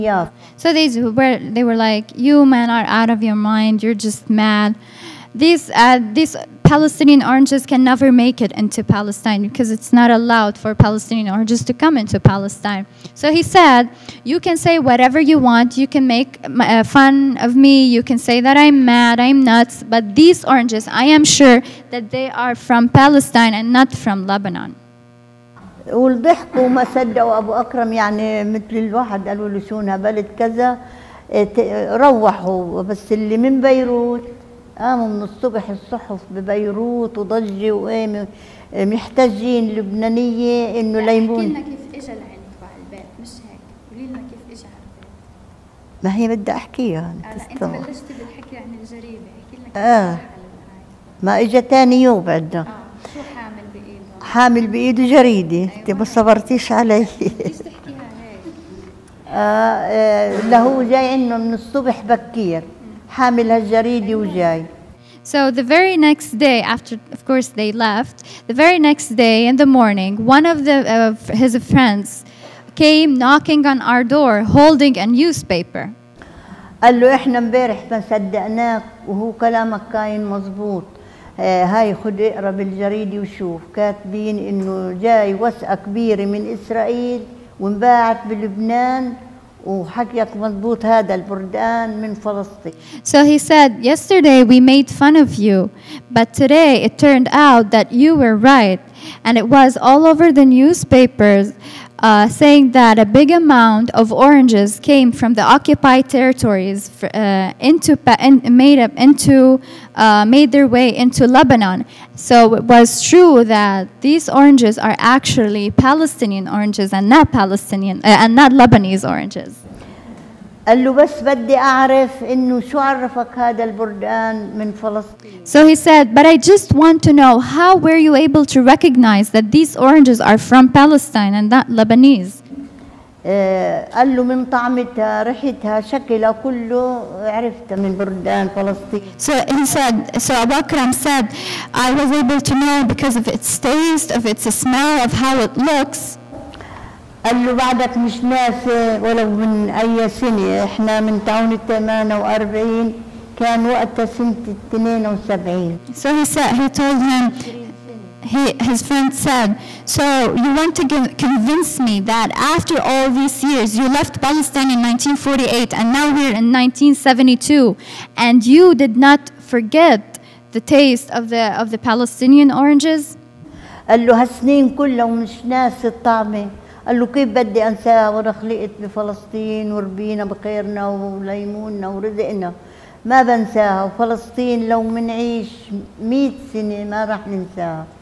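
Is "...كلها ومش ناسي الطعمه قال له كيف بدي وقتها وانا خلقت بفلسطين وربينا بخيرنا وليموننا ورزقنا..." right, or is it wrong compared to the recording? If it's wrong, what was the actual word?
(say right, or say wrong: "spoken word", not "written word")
wrong: "انساها", not "وقتها".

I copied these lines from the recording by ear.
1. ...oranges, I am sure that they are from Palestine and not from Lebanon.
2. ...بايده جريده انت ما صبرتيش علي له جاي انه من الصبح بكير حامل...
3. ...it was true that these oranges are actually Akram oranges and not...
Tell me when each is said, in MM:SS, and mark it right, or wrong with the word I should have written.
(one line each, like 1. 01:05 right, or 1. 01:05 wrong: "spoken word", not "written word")
1. 00:20 right
2. 00:54 right
3. 01:52 wrong: "Palestinian", not "Akram".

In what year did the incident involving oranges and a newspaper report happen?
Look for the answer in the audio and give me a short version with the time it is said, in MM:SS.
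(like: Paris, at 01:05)
1972, at 02:34.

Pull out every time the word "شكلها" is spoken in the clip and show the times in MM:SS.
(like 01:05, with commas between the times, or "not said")
02:15.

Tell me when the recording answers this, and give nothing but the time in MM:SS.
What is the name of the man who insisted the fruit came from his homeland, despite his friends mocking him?
00:27.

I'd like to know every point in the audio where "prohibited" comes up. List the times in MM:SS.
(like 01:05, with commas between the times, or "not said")
not said.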